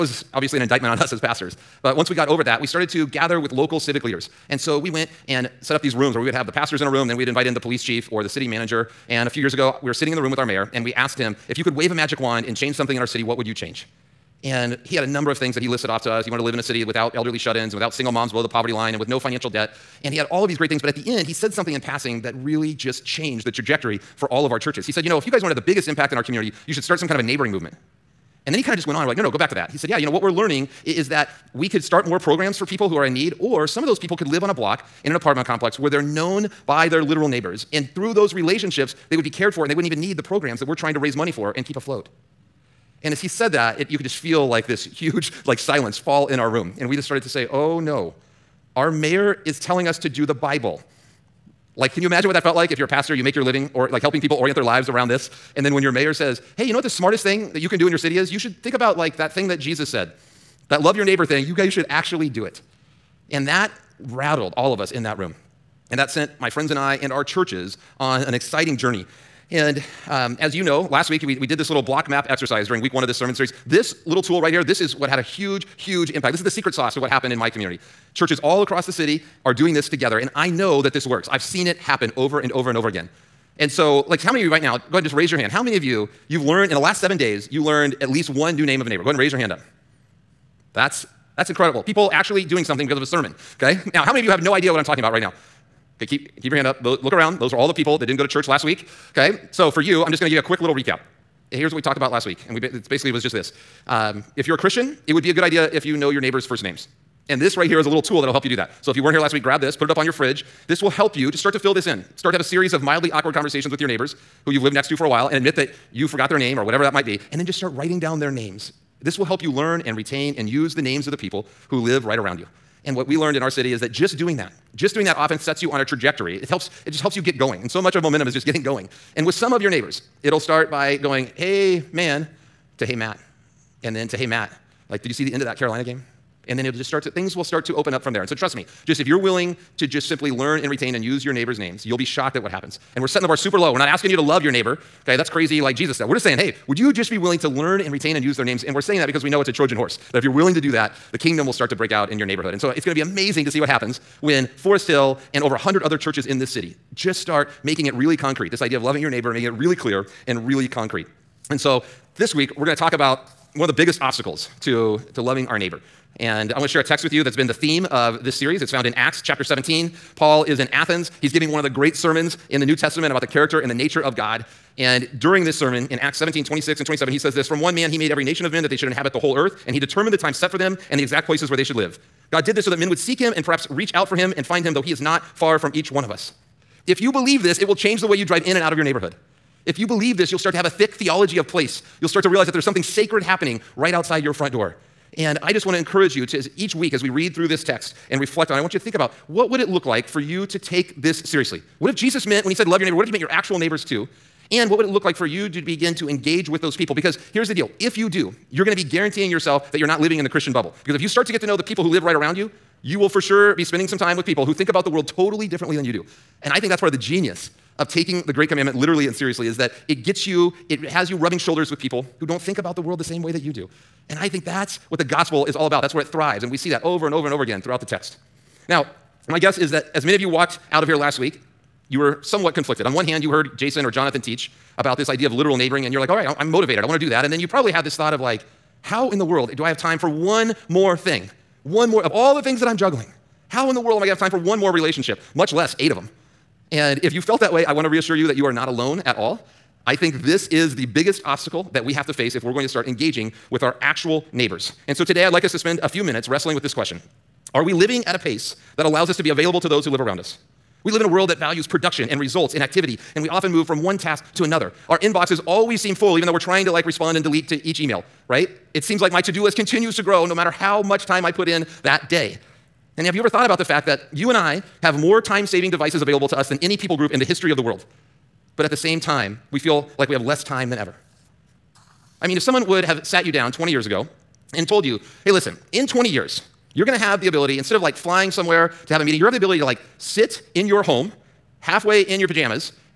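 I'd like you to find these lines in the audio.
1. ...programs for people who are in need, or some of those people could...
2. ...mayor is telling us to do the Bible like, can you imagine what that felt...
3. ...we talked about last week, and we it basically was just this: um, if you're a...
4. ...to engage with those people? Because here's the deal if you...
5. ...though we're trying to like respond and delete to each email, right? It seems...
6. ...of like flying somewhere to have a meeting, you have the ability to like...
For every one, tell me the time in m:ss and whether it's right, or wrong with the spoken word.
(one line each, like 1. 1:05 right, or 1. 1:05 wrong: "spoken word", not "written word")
1. 0:32 right
2. 0:48 right
3. 1:41 right
4. 3:25 right
5. 4:26 right
6. 4:47 right.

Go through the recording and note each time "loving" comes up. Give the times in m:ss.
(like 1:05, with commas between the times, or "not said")
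2:38, 2:45.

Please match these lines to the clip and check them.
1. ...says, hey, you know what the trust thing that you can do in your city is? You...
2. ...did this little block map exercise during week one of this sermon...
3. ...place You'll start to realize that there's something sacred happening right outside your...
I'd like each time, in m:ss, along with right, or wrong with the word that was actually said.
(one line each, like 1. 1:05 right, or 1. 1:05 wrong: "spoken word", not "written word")
1. 0:56 wrong: "smartest", not "trust"
2. 1:11 right
3. 3:11 right.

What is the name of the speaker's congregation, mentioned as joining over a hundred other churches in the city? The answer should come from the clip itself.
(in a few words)
Forest Hill.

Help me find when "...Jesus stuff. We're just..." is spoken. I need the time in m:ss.
2:25.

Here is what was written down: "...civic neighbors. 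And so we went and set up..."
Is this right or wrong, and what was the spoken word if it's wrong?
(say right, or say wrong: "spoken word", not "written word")
wrong: "leaders", not "neighbors".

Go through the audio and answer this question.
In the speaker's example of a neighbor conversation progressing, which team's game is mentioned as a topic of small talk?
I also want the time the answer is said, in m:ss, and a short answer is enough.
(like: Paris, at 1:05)
Carolina, at 2:15.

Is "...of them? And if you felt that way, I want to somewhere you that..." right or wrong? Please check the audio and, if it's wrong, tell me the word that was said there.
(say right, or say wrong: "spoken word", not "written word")
wrong: "reassure", not "somewhere".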